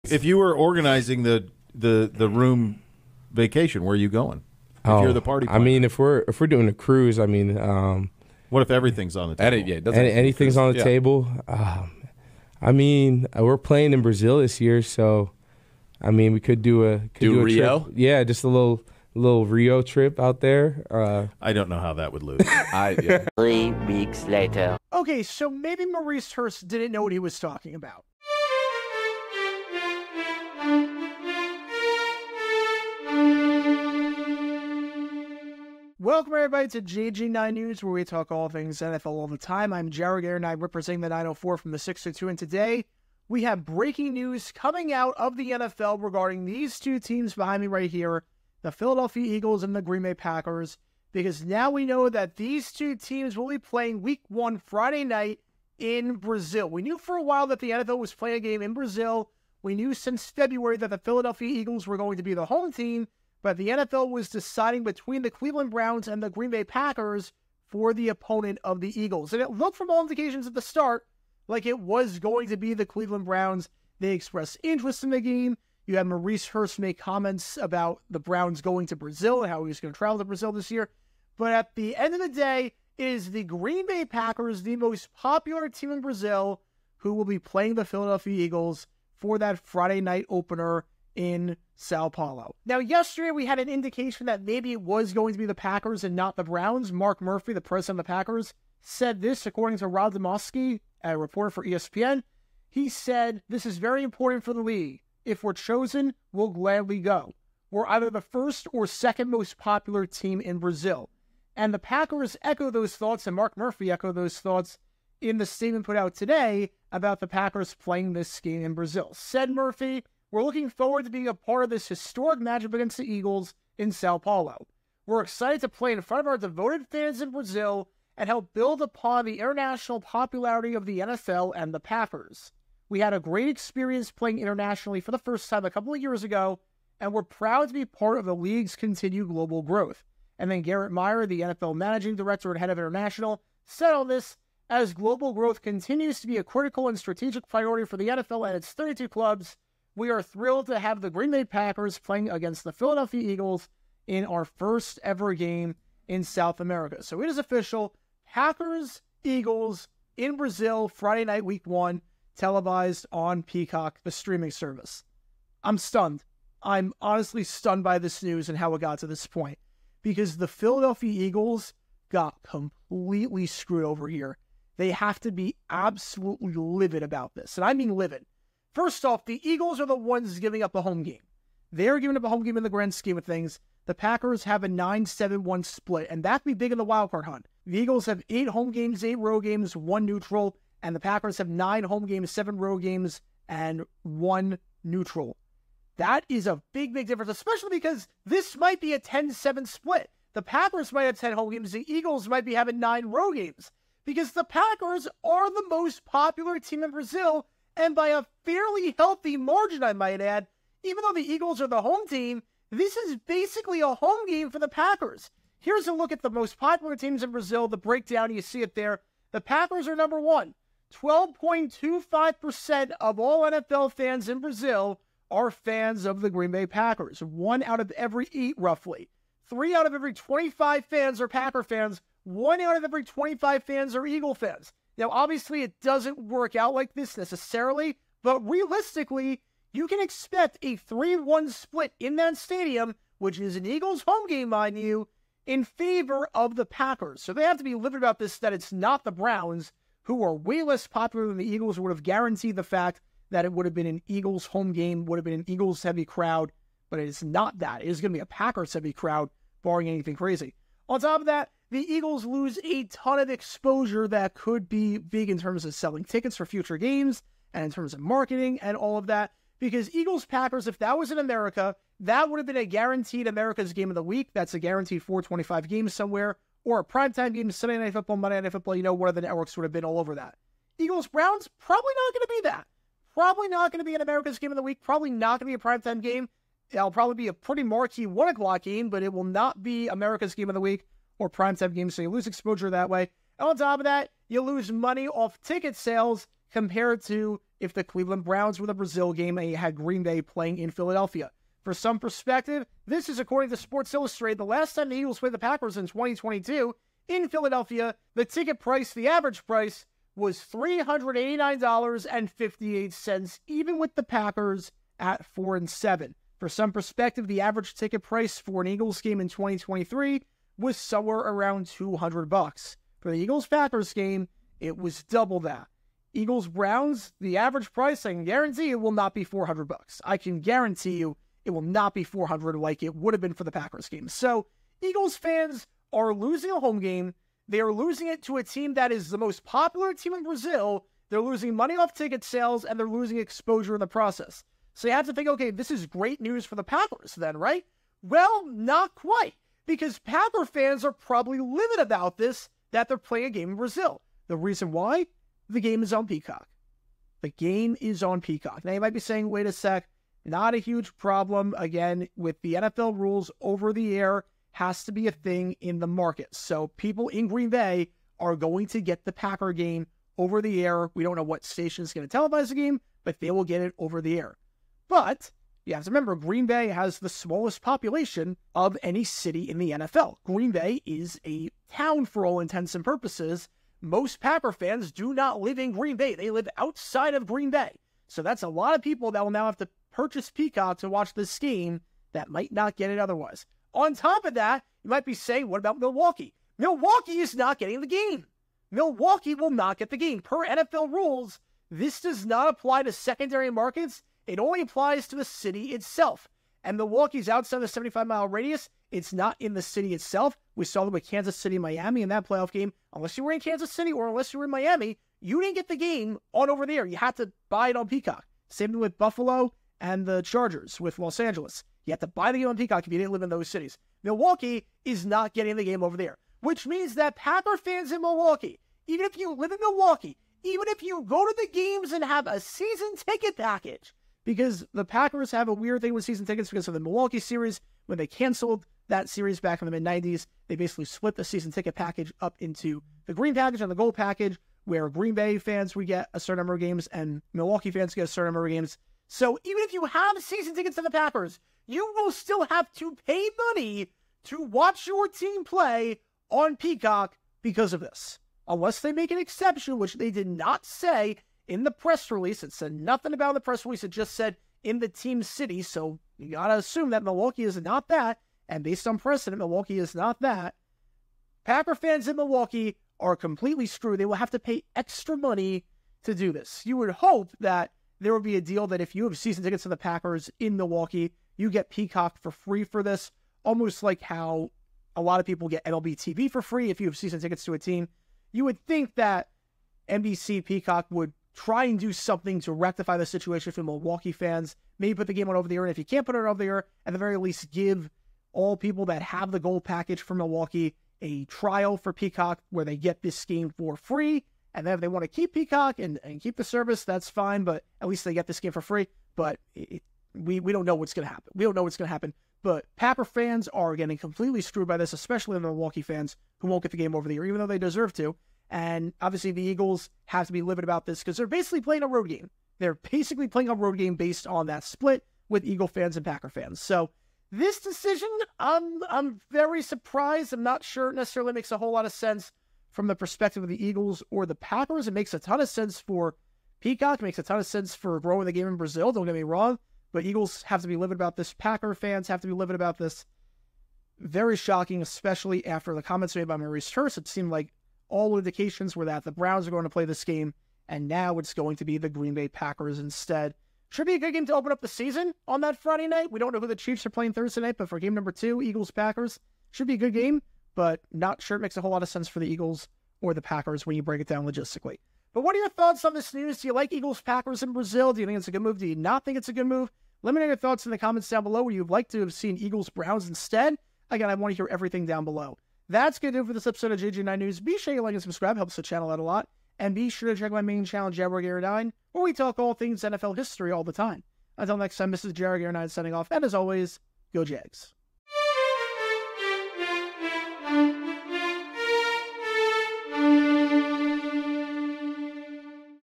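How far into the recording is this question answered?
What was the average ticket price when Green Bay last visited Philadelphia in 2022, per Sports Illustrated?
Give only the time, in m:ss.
5:10.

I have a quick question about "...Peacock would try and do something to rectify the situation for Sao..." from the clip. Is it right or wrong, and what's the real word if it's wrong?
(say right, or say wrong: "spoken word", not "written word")
wrong: "Milwaukee", not "Sao".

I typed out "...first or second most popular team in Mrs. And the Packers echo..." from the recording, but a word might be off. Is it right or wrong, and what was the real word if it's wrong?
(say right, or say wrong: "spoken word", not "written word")
wrong: "Brazil", not "Mrs".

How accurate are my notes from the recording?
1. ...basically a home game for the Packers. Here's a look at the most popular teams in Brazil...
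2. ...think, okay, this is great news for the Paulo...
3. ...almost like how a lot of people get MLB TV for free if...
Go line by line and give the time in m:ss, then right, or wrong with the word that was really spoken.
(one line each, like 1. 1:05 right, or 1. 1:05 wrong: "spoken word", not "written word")
1. 3:33 right
2. 5:45 wrong: "Packers", not "Paulo"
3. 8:03 right.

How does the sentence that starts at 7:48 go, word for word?
And based on precedent, Milwaukee is not that.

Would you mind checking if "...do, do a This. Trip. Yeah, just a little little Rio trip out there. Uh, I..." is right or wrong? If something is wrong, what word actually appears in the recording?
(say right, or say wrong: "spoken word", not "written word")
wrong: "Rio", not "This".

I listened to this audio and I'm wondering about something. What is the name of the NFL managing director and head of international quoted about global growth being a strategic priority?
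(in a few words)
Gerrit Meier.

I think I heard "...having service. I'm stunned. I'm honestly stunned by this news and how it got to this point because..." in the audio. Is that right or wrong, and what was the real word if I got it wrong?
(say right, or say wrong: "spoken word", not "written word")
wrong: "streaming", not "having".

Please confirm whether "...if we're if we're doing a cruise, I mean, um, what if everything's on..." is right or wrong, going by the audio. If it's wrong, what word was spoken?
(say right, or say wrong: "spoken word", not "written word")
right.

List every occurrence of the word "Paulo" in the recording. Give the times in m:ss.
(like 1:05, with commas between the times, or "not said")
1:32, 2:04.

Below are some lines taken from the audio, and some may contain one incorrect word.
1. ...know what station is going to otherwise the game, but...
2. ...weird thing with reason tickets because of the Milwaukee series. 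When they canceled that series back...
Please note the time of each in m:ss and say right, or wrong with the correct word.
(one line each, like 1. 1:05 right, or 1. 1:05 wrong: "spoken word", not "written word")
1. 6:11 wrong: "televise", not "otherwise"
2. 7:15 wrong: "season", not "reason".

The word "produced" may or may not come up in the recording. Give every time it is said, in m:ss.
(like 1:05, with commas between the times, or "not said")
not said.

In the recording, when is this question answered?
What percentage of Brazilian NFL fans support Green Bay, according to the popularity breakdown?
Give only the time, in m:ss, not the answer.
3:40.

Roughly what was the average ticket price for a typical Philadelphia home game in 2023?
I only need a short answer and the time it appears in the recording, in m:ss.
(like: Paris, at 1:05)
$200, at 5:21.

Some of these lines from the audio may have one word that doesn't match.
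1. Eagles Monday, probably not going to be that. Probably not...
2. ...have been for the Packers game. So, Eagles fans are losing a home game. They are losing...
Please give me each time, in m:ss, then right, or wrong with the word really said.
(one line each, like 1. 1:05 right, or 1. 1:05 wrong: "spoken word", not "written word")
1. 4:40 wrong: "Browns", not "Monday"
2. 5:33 right.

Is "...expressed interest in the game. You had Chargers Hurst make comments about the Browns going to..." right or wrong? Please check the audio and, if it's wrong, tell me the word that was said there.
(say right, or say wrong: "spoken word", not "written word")
wrong: "Maurice", not "Chargers".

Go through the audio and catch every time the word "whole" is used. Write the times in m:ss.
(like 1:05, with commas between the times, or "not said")
8:51, 9:21.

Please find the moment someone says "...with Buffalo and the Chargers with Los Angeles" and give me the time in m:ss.
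6:58.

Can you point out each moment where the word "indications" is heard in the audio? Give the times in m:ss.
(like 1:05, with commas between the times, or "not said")
1:10, 1:33, 9:08.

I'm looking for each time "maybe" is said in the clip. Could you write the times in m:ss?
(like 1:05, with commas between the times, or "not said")
0:25, 1:34, 8:14.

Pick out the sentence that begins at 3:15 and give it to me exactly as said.
That is a big, big difference, especially because this might be a 10 7 split.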